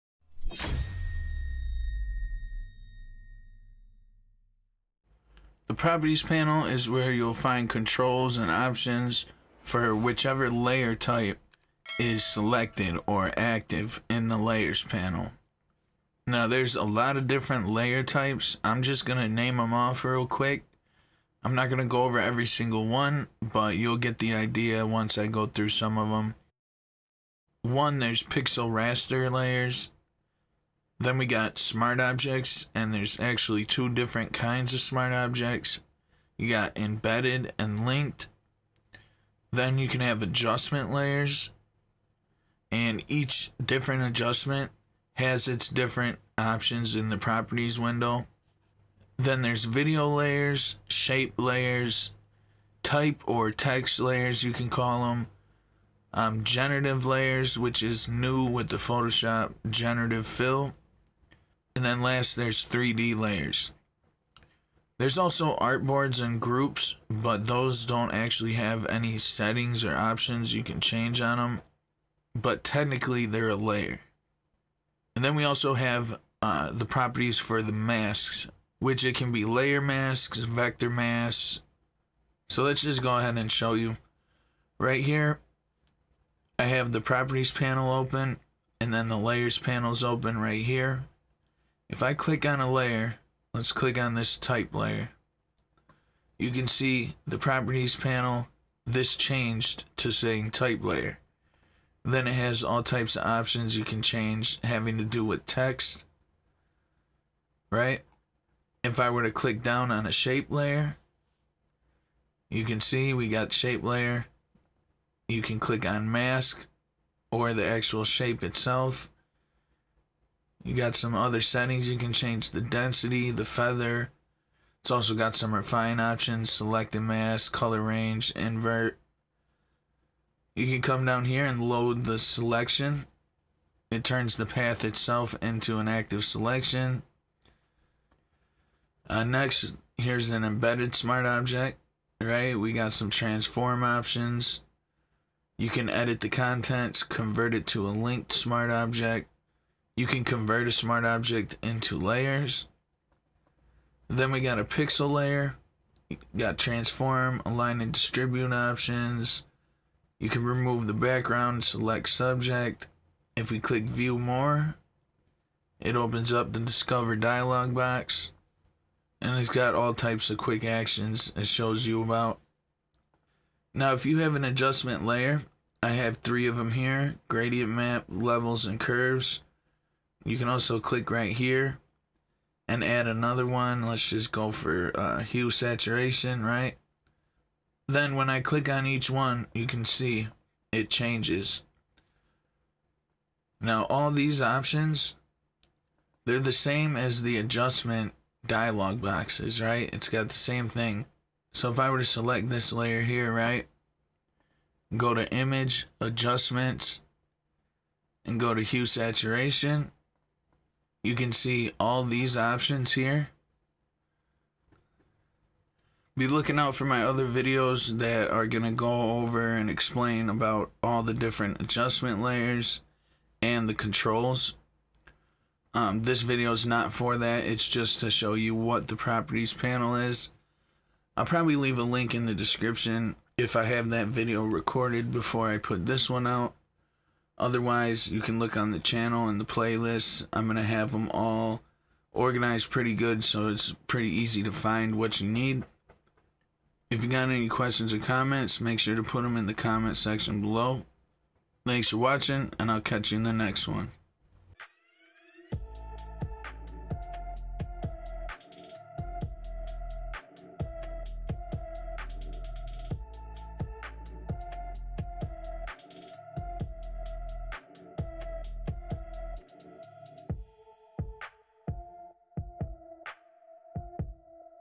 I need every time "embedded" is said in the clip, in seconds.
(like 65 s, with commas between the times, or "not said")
36 s, 140 s.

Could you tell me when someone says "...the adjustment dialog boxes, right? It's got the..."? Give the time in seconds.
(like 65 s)
197 s.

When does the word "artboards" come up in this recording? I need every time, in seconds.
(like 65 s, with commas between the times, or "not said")
65 s.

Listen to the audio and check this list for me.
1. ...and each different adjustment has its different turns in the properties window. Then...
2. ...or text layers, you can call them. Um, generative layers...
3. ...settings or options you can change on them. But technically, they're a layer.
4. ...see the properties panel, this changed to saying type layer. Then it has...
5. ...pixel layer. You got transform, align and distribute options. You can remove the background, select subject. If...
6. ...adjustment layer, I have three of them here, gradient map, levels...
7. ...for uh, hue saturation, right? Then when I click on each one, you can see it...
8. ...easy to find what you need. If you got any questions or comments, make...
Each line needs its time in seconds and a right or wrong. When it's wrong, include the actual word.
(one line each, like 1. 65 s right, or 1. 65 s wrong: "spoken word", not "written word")
1. 42 s wrong: "options", not "turns"
2. 53 s right
3. 69 s right
4. 96 s right
5. 154 s right
6. 174 s right
7. 184 s right
8. 244 s right.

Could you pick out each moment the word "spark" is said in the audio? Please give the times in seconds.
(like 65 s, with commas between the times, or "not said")
not said.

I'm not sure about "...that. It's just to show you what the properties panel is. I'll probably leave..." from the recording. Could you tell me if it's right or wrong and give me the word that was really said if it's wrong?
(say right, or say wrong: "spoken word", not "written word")
right.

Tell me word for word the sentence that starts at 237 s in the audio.
Otherwise, you can look on the channel and the playlists.